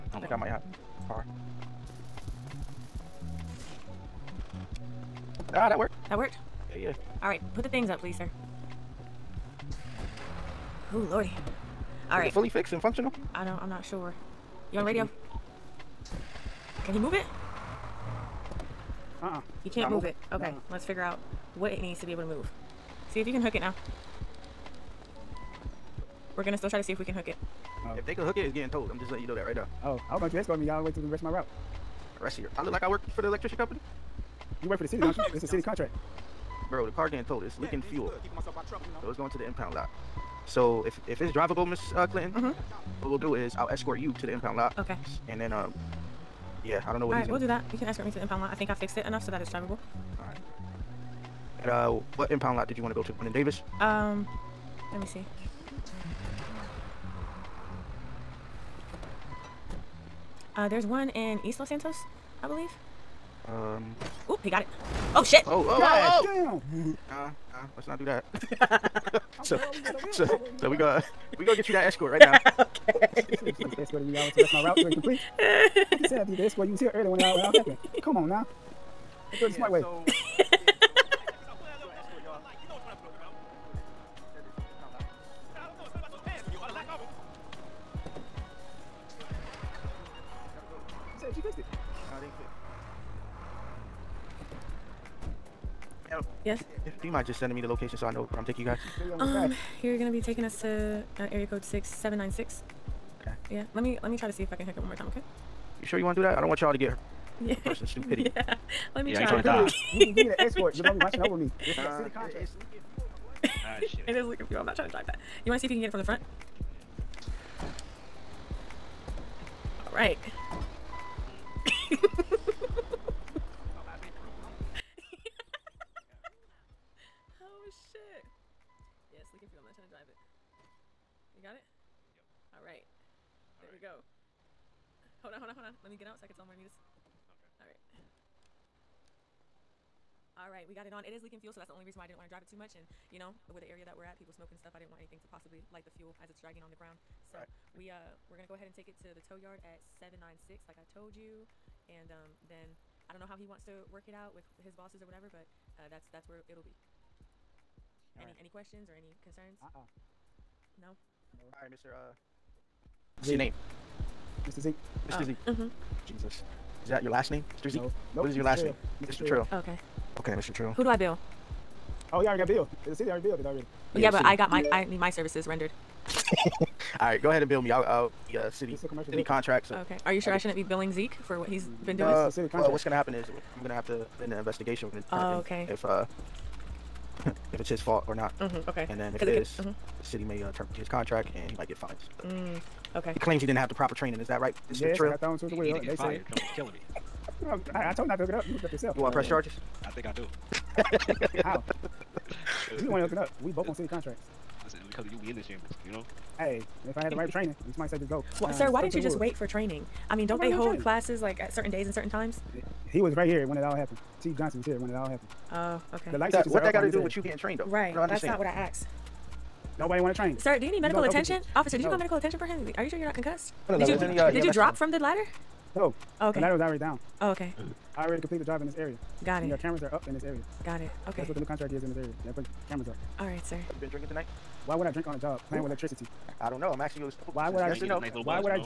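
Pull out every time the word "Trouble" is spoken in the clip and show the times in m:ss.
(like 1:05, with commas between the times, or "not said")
0:38.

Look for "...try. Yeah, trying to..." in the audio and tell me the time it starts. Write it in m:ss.
1:49.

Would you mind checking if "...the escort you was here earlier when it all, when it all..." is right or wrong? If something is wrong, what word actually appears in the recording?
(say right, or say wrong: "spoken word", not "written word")
right.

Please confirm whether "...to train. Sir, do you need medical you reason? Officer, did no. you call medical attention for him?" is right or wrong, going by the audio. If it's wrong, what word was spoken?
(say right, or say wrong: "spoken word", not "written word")
wrong: "attention", not "reason".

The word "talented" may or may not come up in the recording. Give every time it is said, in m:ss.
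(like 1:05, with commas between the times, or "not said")
not said.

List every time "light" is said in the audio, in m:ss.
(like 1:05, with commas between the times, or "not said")
2:25, 3:36.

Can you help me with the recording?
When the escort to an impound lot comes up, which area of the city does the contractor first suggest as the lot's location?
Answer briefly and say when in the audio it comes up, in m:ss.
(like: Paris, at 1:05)
East Los Santos, at 1:01.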